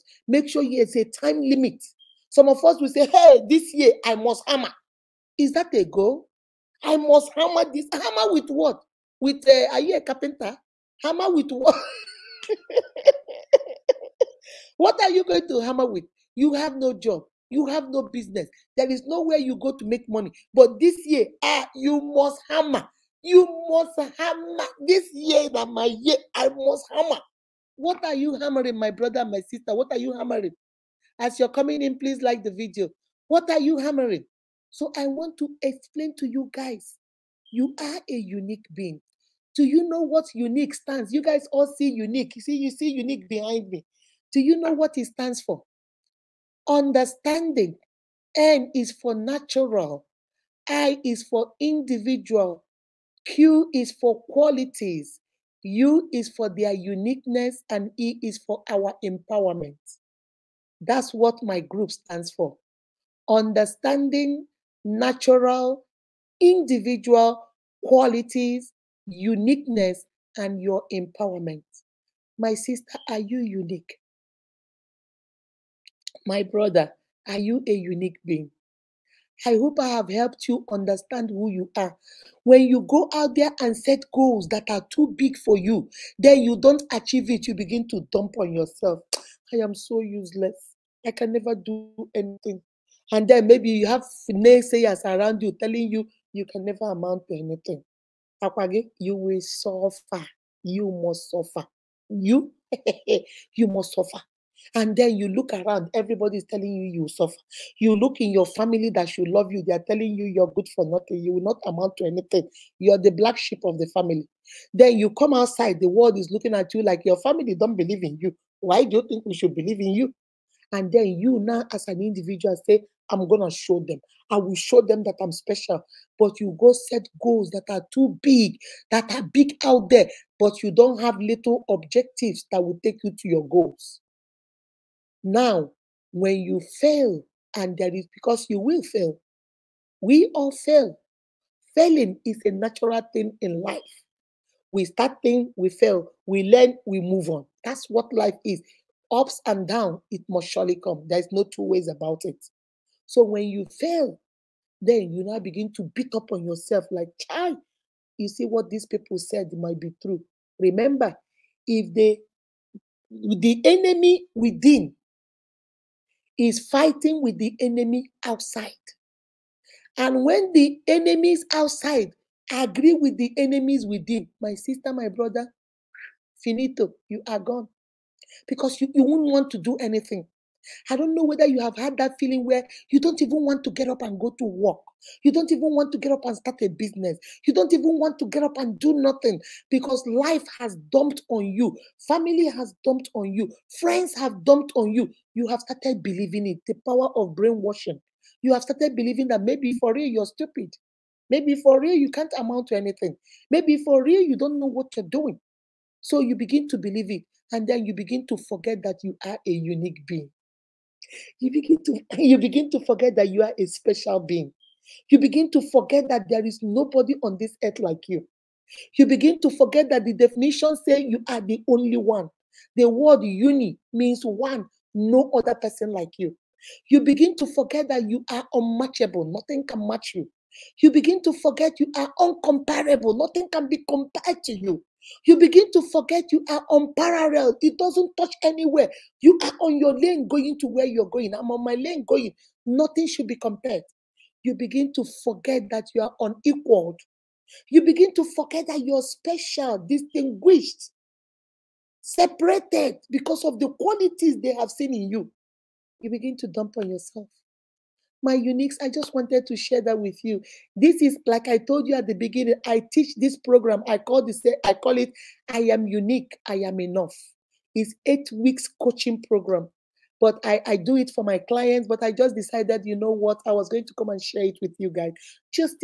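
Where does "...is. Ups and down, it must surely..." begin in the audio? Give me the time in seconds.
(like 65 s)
148 s.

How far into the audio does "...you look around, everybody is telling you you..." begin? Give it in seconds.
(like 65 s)
105 s.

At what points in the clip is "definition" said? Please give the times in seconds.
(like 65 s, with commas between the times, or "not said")
220 s.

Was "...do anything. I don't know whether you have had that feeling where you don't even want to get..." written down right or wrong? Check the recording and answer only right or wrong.
right.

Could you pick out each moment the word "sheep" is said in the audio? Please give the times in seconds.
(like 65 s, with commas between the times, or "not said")
113 s.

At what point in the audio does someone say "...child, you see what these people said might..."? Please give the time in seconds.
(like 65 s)
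157 s.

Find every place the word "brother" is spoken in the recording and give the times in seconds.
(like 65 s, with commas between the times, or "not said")
28 s, 76 s, 175 s.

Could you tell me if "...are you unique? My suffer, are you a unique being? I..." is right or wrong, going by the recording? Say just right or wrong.
wrong.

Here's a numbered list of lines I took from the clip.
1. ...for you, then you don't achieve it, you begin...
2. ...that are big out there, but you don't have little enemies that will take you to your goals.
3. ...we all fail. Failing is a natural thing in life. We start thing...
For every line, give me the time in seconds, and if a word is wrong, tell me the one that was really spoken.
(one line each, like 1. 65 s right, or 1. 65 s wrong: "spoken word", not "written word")
1. 85 s right
2. 128 s wrong: "objectives", not "enemies"
3. 139 s right.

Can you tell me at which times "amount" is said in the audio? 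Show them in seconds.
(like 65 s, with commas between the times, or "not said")
96 s, 111 s, 202 s.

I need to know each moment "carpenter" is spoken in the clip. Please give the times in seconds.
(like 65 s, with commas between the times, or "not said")
10 s.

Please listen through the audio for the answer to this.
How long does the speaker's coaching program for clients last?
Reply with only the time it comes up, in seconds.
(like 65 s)
268 s.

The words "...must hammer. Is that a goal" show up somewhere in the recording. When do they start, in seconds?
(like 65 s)
4 s.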